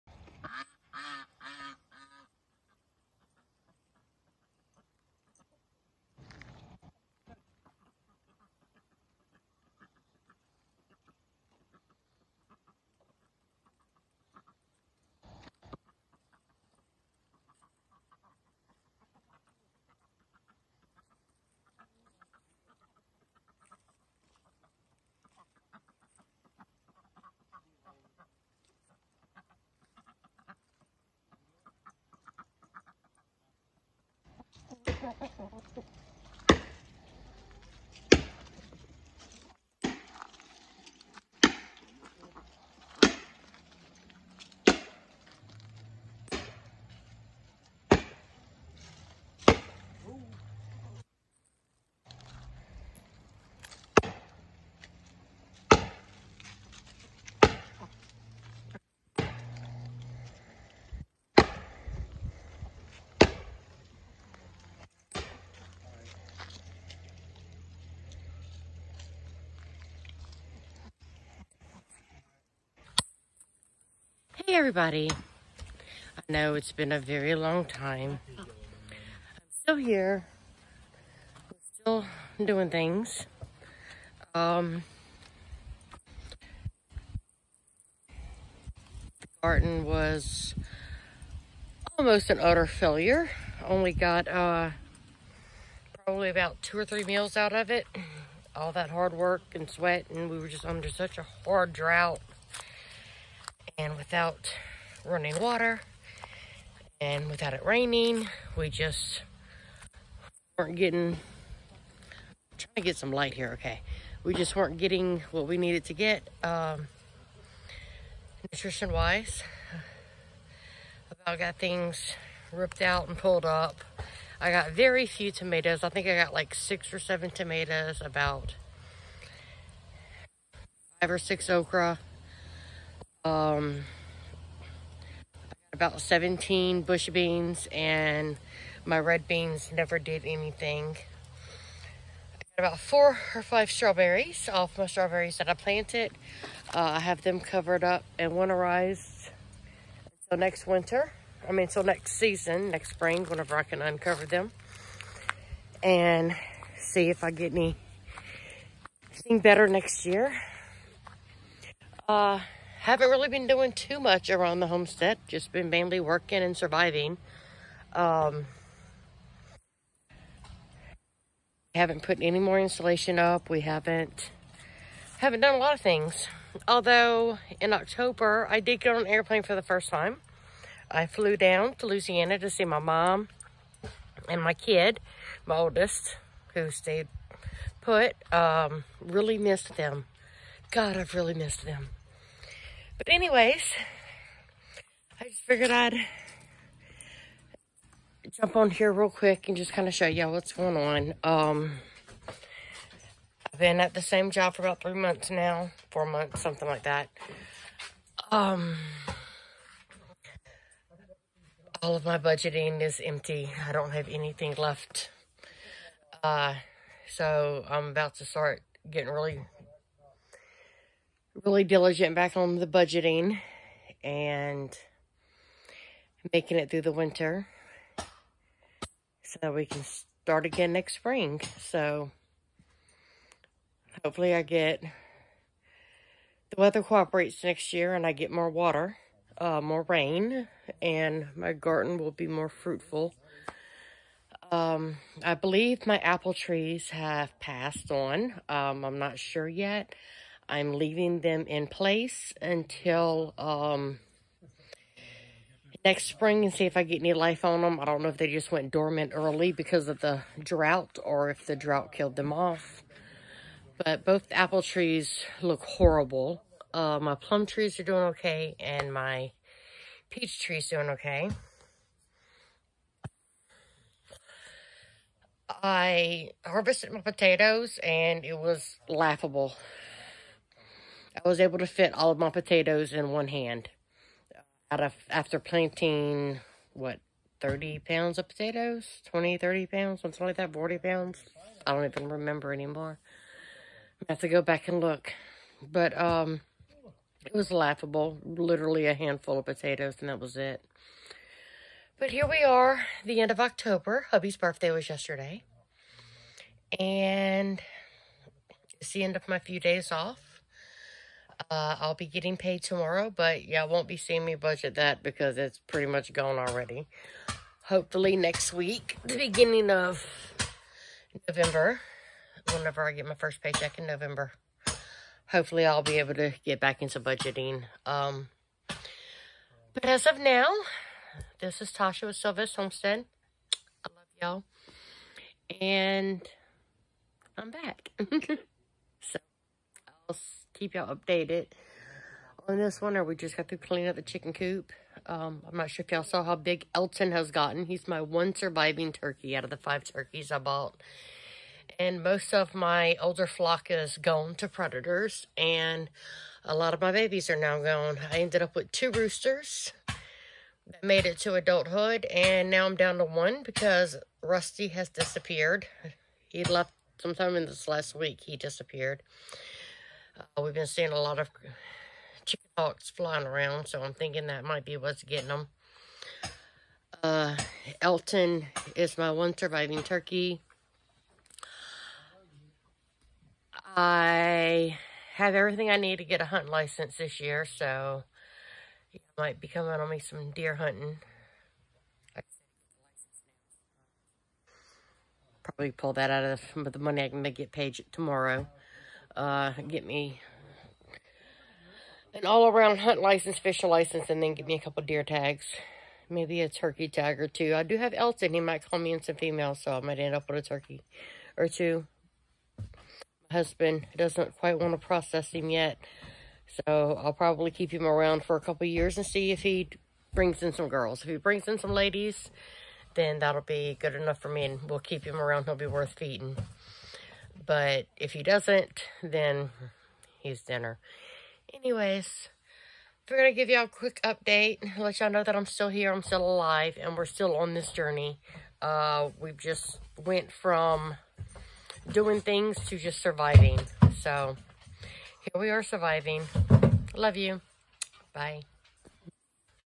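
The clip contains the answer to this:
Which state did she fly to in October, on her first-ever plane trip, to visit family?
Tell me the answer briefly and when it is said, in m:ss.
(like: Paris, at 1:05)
Louisiana, at 3:01.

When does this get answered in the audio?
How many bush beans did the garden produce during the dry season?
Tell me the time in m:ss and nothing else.
2:16.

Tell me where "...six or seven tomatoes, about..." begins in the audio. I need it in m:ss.
2:06.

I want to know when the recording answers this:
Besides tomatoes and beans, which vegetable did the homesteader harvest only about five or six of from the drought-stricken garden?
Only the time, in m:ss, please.
2:11.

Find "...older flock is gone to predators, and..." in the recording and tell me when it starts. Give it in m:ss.
5:53.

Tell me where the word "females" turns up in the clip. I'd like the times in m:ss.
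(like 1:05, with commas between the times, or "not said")
6:49.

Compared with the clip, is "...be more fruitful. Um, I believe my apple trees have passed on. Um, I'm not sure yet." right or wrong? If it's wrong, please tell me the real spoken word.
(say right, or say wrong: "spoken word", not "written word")
right.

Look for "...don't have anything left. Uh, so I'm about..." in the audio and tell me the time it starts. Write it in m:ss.
3:33.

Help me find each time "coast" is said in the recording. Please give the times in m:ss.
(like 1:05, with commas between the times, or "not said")
not said.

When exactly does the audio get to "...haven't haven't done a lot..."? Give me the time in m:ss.
2:53.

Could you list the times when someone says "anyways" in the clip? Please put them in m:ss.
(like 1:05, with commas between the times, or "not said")
3:13, 7:11.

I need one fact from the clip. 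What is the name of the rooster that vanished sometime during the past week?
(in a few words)
Rusty.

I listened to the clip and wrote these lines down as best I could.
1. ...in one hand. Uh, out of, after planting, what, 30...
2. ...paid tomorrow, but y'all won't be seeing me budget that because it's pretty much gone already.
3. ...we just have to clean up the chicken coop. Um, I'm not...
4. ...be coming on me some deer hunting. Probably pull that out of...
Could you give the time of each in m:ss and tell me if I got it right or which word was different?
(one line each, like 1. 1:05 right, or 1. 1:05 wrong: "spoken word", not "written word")
1. 4:42 right
2. 5:12 right
3. 5:43 right
4. 6:29 right.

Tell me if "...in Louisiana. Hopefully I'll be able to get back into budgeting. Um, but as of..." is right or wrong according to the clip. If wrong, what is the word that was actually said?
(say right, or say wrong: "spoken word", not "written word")
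wrong: "November", not "Louisiana".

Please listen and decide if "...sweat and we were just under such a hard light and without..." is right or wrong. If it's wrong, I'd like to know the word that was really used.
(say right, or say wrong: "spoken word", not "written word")
wrong: "drought", not "light".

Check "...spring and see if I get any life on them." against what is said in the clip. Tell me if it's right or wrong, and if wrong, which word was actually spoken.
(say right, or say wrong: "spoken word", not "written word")
right.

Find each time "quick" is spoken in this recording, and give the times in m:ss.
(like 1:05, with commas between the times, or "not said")
3:19, 7:13.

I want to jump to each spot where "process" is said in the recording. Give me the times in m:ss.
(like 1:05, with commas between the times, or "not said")
6:54.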